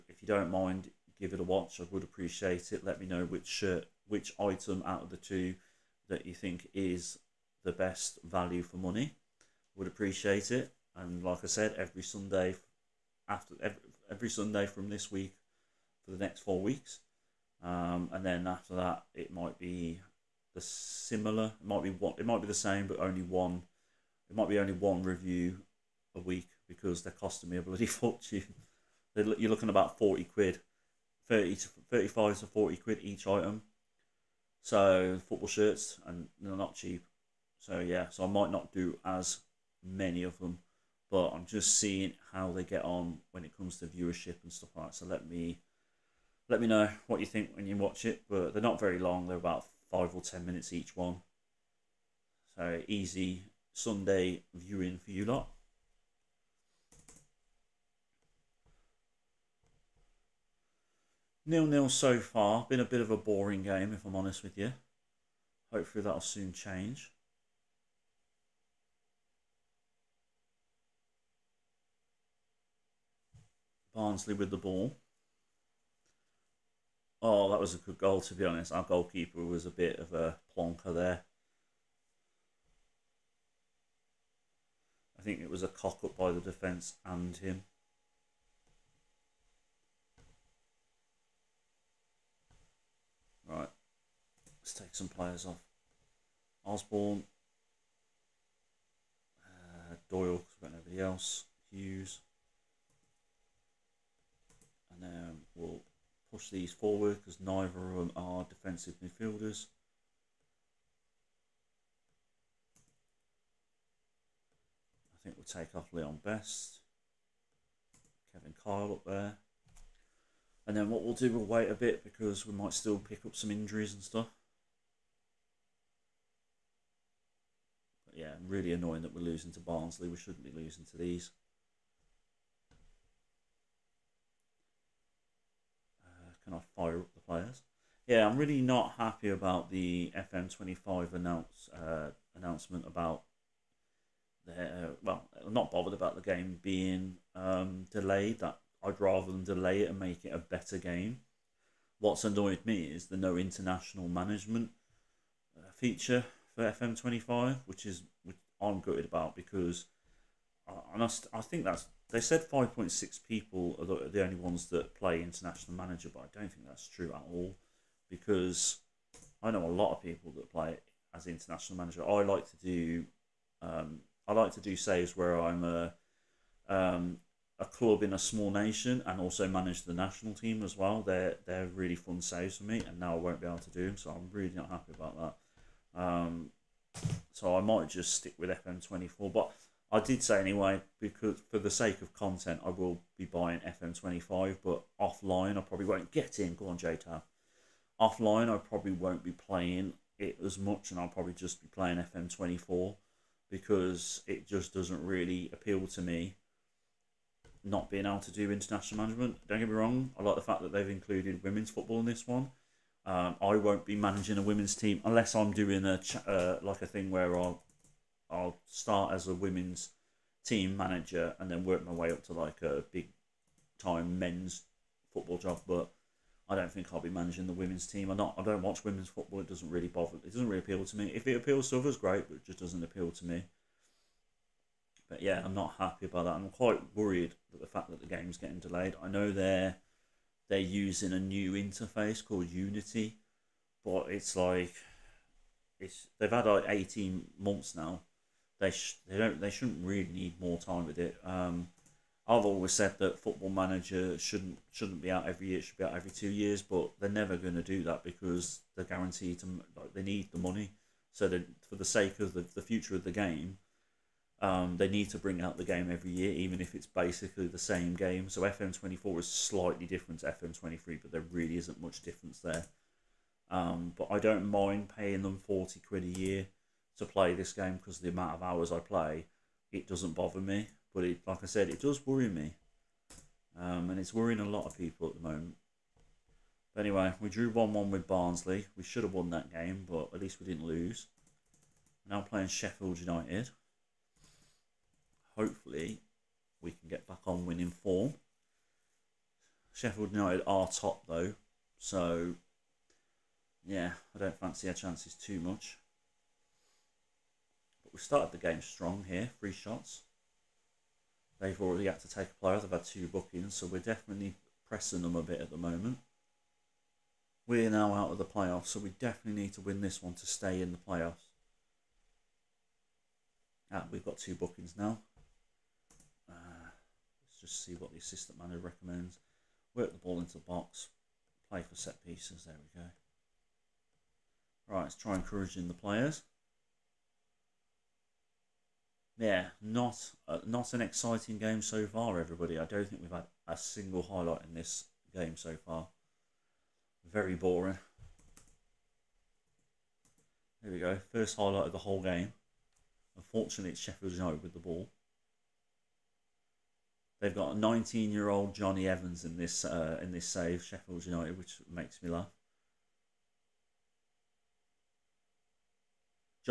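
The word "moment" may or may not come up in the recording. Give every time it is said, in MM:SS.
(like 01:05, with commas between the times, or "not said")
04:45, 05:15.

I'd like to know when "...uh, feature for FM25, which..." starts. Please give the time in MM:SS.
02:35.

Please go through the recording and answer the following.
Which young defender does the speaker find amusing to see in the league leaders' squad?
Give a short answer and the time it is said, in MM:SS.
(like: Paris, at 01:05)
Jonny Evans, at 05:58.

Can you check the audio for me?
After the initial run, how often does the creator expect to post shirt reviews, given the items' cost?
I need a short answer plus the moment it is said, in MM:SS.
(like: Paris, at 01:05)
one review a week, at 00:24.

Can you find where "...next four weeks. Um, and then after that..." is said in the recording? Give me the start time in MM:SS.
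00:16.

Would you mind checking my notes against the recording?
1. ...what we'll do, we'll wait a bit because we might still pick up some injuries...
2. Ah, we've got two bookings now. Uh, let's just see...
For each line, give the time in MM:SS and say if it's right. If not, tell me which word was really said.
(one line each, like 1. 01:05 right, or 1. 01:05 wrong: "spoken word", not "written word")
1. 02:00 right
2. 05:23 right.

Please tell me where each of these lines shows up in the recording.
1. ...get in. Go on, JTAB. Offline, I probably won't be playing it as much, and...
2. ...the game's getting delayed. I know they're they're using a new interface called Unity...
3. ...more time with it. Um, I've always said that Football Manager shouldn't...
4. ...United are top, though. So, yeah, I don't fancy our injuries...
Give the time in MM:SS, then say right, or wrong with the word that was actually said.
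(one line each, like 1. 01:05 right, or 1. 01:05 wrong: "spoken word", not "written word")
1. 03:16 right
2. 03:57 right
3. 04:10 right
4. 05:00 wrong: "chances", not "injuries".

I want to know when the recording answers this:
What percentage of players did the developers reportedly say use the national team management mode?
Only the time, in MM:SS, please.
02:42.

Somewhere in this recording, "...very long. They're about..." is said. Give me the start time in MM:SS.
00:48.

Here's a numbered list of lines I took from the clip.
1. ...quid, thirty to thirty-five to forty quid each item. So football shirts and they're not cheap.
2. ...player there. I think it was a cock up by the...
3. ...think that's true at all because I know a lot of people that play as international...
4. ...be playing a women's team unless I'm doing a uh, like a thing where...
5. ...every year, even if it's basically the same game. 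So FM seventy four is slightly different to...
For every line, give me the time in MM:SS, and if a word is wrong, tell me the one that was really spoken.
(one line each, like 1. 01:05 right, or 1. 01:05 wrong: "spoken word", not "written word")
1. 00:30 right
2. 01:20 wrong: "plonker", not "player"
3. 02:46 right
4. 03:33 wrong: "managing", not "playing"
5. 04:25 wrong: "twenty", not "seventy".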